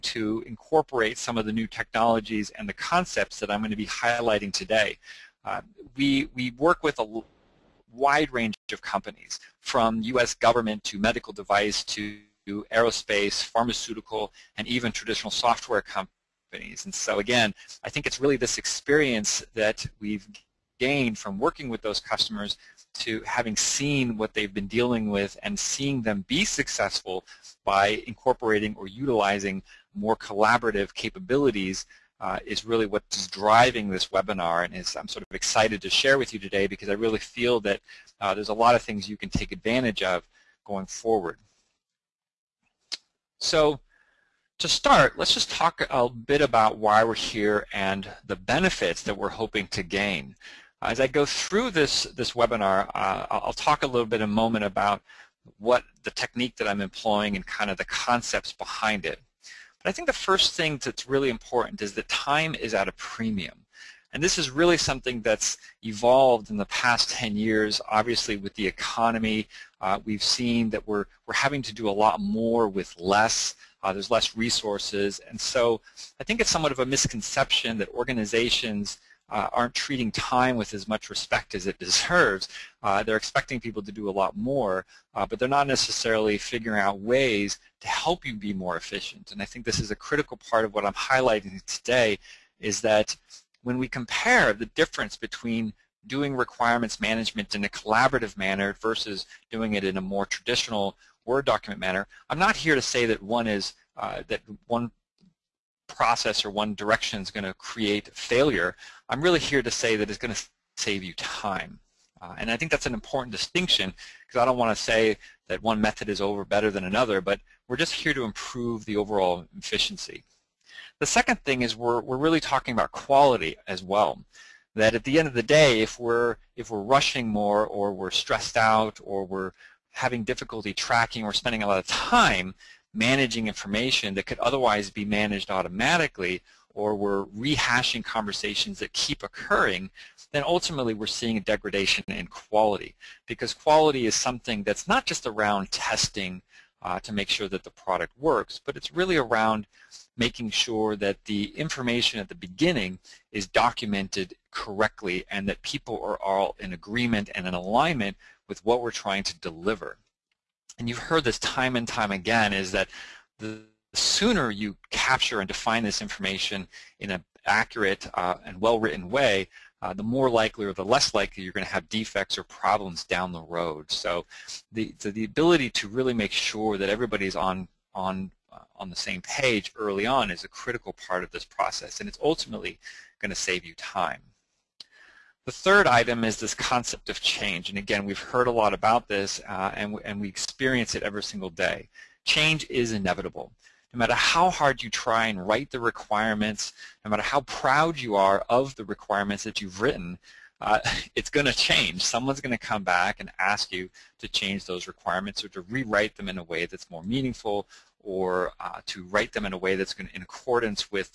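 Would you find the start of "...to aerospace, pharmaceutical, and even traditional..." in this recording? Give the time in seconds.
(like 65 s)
11 s.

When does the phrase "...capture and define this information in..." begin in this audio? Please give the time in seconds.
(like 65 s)
164 s.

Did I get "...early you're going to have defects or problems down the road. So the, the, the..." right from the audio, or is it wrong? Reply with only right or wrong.
wrong.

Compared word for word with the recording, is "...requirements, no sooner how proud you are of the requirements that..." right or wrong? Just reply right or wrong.
wrong.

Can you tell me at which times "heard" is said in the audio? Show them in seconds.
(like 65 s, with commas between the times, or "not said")
160 s, 188 s.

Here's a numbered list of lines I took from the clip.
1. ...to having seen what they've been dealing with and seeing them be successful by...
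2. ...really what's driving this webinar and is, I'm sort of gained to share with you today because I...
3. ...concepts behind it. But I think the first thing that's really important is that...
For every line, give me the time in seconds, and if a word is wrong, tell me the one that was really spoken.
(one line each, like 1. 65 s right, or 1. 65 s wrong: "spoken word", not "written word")
1. 22 s right
2. 32 s wrong: "excited", not "gained"
3. 57 s right.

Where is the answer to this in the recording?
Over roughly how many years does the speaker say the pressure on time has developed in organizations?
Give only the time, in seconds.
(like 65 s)
66 s.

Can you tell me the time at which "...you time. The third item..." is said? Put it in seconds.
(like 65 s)
183 s.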